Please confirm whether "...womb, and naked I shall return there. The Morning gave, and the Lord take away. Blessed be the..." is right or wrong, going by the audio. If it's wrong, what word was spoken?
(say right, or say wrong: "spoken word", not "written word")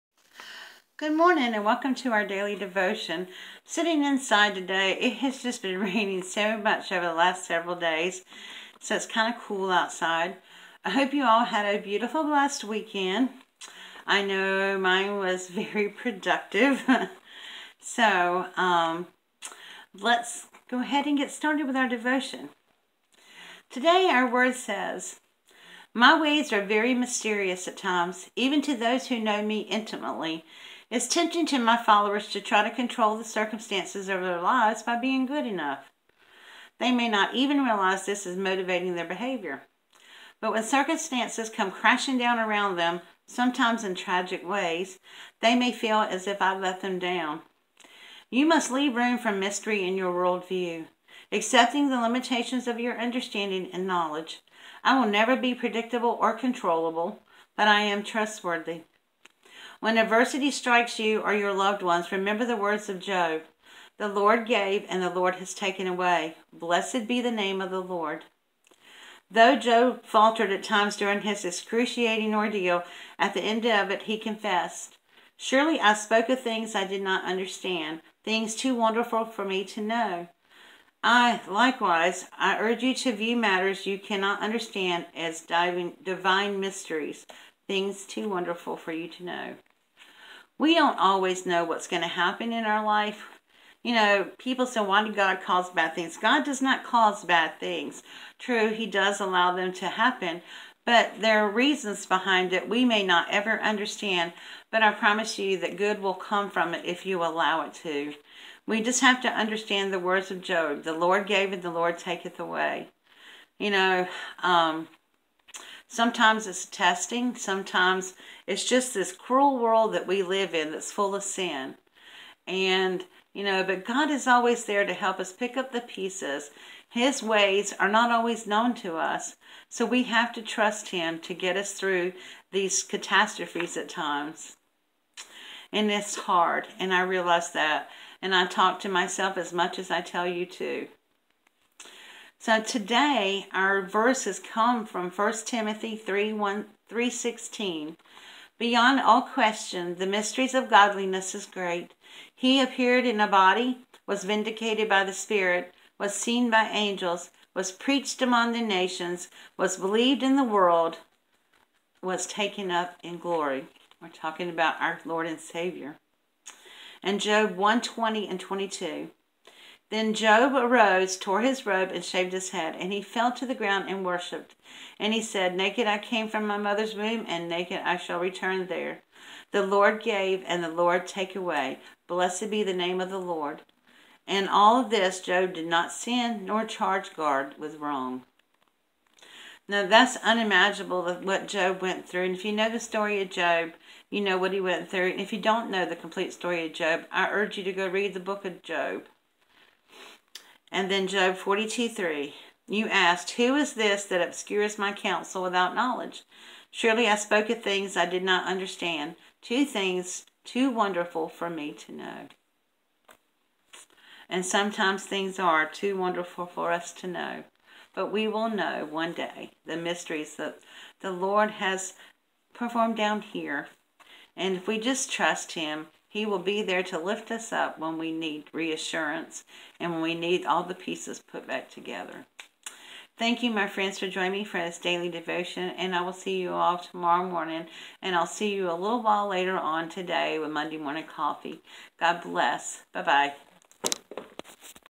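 wrong: "Lord", not "Morning".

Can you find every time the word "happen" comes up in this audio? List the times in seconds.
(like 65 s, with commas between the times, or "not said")
92 s, 99 s.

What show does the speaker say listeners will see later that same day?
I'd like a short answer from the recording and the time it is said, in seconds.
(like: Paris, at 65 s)
Monday Morning Coffee, at 240 s.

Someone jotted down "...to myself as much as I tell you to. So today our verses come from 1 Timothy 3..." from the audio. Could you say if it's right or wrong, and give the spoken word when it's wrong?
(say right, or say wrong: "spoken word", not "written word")
right.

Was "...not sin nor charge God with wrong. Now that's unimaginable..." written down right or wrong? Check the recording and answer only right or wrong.
right.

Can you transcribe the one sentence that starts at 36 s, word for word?
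They may not even realize this is motivating their behavior.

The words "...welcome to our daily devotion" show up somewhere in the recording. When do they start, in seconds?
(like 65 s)
1 s.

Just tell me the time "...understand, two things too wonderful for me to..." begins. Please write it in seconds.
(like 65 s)
208 s.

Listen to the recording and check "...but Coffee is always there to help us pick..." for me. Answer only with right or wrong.
wrong.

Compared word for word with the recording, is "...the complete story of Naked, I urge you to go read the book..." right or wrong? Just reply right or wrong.
wrong.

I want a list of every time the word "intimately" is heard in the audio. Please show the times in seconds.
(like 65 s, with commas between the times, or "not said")
29 s.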